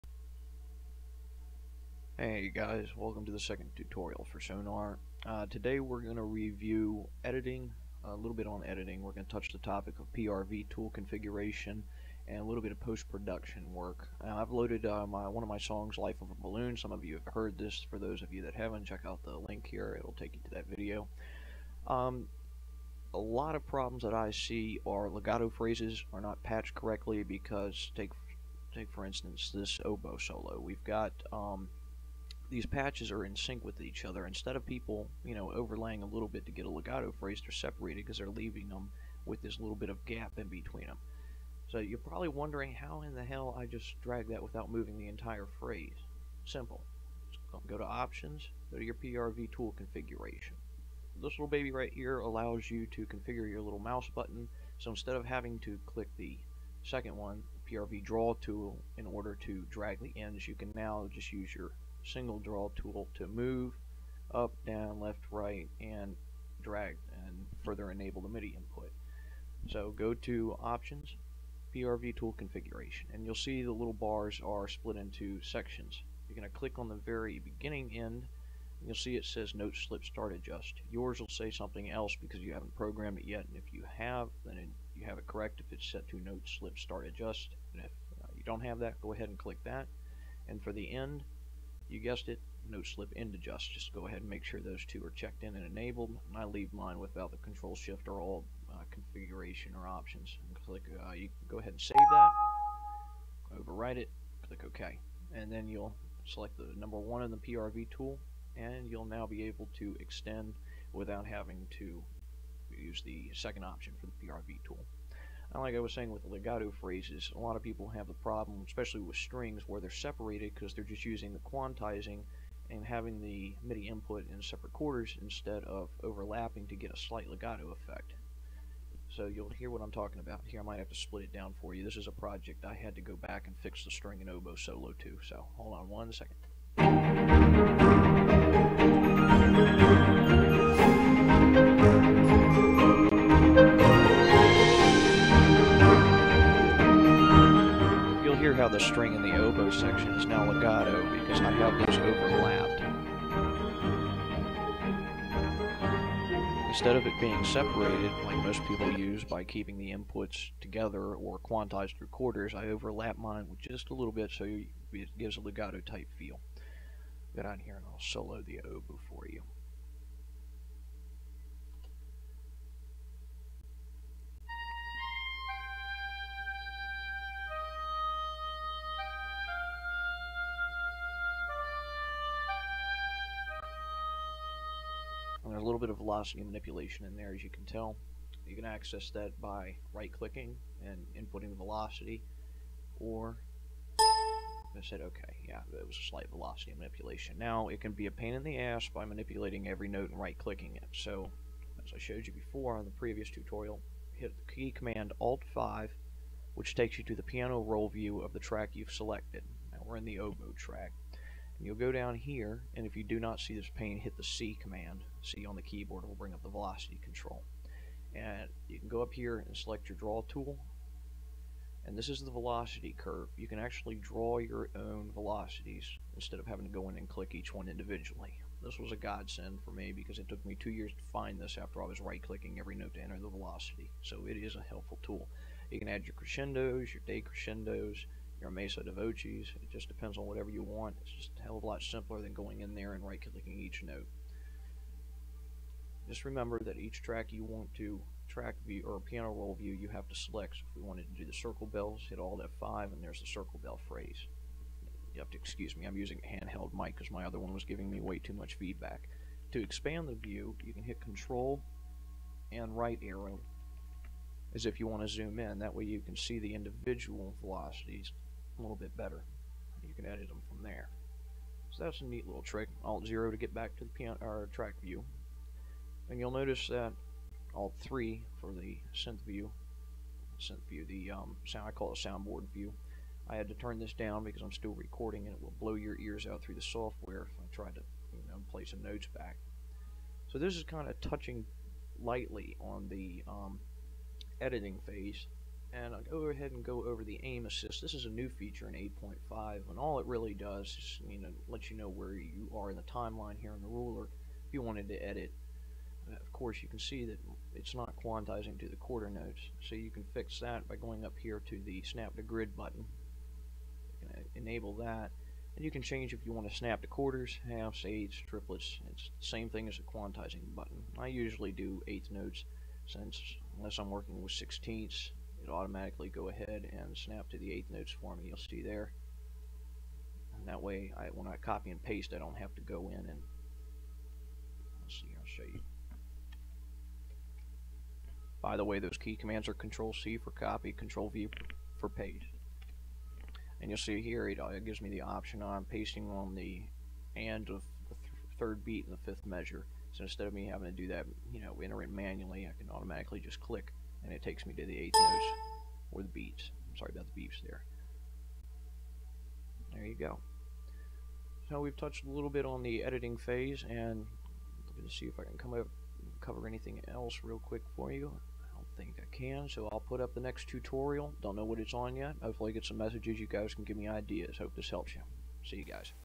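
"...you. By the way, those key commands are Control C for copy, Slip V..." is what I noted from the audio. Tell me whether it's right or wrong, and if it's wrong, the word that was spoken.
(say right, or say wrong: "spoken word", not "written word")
wrong: "Control", not "Slip".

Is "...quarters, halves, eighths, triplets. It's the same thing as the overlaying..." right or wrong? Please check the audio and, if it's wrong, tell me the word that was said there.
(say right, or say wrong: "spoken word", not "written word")
wrong: "quantizing", not "overlaying".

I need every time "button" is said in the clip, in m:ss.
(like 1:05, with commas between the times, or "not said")
0:54, 5:12, 5:20.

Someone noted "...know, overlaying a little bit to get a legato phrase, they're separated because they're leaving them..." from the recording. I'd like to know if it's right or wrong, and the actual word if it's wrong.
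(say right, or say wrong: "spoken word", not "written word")
right.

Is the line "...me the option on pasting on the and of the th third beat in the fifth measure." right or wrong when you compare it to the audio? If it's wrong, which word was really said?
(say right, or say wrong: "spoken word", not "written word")
right.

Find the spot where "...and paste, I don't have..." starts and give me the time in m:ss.
5:31.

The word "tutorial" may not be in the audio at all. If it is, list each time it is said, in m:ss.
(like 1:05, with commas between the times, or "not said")
0:03, 3:23, 6:10.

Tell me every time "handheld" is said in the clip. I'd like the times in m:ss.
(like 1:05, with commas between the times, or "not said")
4:16.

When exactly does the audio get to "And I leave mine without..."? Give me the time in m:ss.
1:36.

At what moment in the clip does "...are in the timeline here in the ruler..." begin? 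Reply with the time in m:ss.
5:02.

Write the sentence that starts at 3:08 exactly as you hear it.
You can access that by right-clicking and inputting the velocity, or I said, okay, yeah, it was a slight velocity manipulation.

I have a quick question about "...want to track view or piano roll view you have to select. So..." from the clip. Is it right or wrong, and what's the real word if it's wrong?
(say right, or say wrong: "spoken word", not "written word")
right.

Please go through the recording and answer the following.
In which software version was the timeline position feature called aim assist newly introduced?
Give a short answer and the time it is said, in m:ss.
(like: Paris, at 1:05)
8.5, at 4:58.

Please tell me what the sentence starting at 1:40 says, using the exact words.
And click, uh, you can go ahead and save that, overwrite it, click OK.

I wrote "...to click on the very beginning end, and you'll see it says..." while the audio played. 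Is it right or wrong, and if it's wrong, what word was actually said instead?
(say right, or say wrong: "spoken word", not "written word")
right.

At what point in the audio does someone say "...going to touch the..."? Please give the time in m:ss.
0:09.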